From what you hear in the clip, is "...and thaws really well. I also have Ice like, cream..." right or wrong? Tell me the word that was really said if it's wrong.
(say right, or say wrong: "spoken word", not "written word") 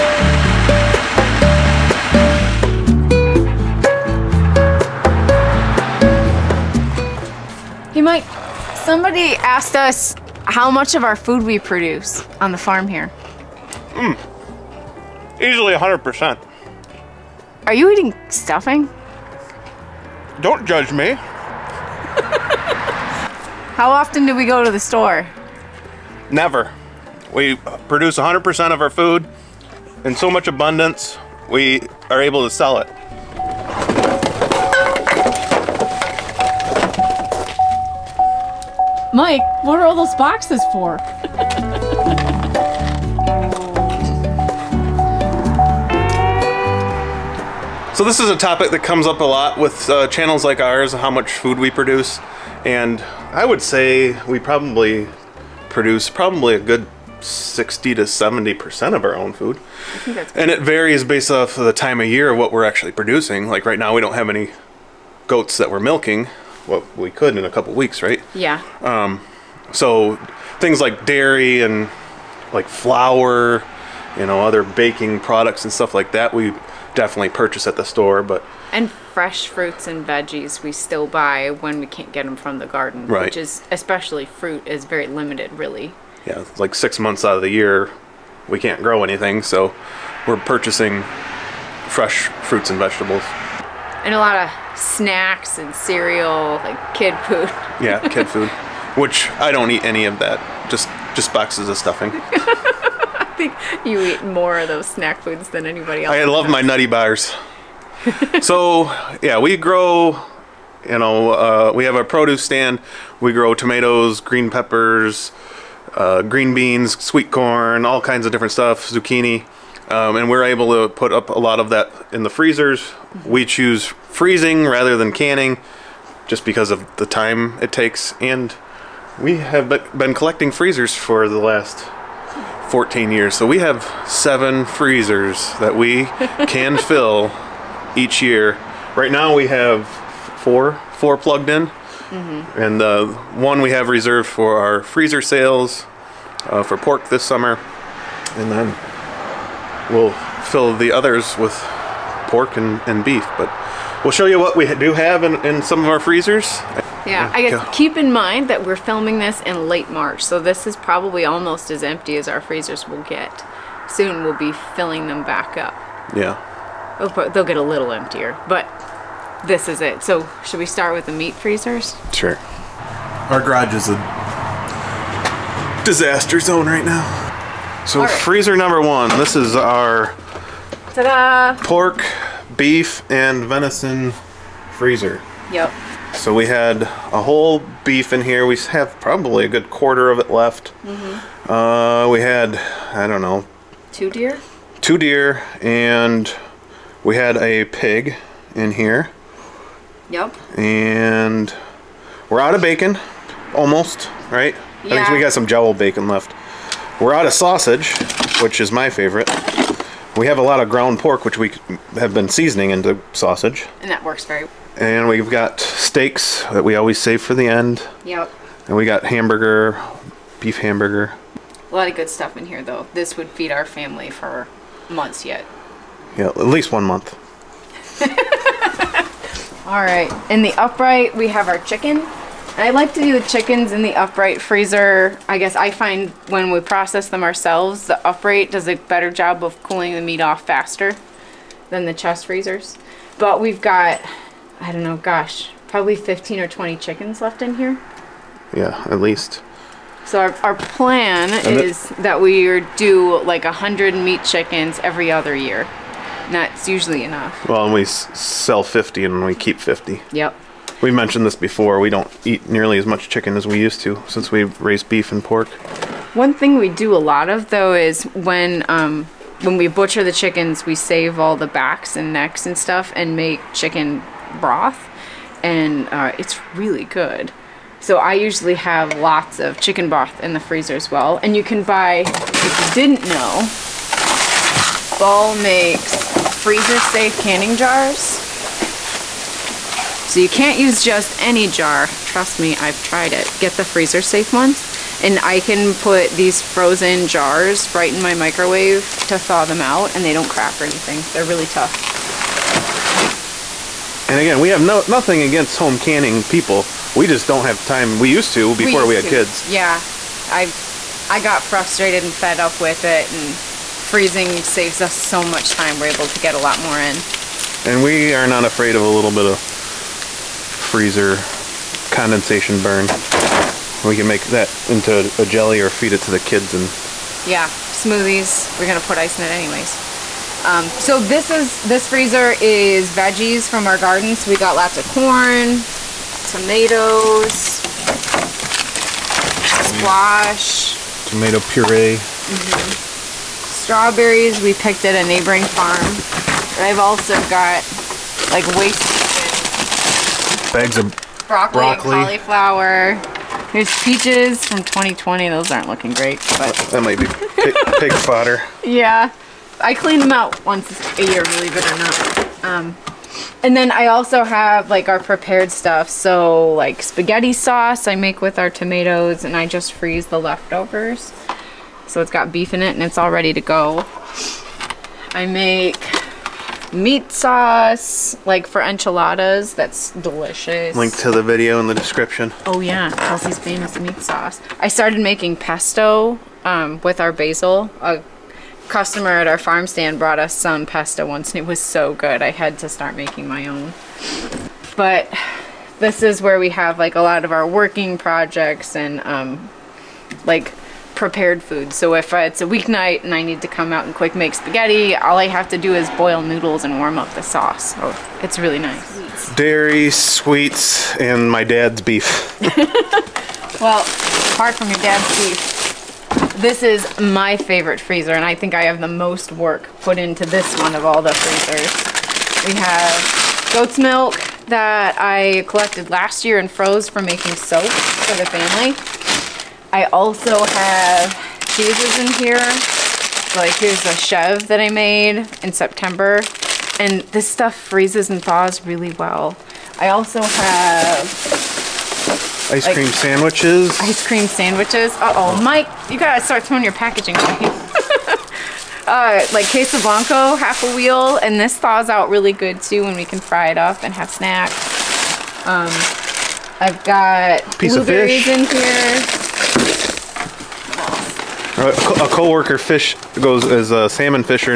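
right.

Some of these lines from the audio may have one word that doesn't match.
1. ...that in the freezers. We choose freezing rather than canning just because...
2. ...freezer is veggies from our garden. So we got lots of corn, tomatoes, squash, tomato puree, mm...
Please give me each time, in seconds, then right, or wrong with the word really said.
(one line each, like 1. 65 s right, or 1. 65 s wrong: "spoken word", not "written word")
1. 121 s right
2. 331 s right.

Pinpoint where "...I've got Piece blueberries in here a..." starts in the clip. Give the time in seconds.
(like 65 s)
456 s.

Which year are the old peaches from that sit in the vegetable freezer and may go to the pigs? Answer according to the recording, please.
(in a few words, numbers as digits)
2020.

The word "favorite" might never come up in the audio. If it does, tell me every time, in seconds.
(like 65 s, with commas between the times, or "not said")
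208 s, 417 s.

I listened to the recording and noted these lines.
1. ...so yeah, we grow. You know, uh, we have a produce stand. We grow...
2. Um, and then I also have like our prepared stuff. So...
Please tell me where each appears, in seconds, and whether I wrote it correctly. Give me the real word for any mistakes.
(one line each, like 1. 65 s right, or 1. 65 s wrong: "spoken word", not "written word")
1. 108 s right
2. 362 s right.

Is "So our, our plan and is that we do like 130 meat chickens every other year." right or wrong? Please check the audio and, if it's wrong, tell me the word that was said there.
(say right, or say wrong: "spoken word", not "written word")
wrong: "100", not "130".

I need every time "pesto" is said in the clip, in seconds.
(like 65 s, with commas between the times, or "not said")
385 s, 390 s.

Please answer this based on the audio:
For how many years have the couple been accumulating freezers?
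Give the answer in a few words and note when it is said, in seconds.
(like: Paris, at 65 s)
14 years, at 132 s.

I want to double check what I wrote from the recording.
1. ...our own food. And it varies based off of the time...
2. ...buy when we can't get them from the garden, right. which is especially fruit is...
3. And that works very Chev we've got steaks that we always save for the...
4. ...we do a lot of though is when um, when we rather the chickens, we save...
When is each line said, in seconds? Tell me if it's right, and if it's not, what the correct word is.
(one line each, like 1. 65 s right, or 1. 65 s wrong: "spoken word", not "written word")
1. 59 s right
2. 81 s right
3. 213 s wrong: "And", not "Chev"
4. 266 s wrong: "butcher", not "rather".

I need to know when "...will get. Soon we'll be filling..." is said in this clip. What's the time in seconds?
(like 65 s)
162 s.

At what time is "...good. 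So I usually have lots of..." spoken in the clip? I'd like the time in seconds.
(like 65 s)
276 s.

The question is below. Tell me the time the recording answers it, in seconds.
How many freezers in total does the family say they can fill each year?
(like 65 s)
134 s.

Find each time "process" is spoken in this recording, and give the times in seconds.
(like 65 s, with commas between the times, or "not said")
236 s.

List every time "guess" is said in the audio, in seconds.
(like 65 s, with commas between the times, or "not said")
157 s, 235 s.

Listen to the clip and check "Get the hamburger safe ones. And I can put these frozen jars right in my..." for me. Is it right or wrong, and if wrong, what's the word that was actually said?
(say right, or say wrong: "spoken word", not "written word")
wrong: "freezer", not "hamburger".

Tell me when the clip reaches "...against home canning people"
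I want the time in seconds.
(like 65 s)
305 s.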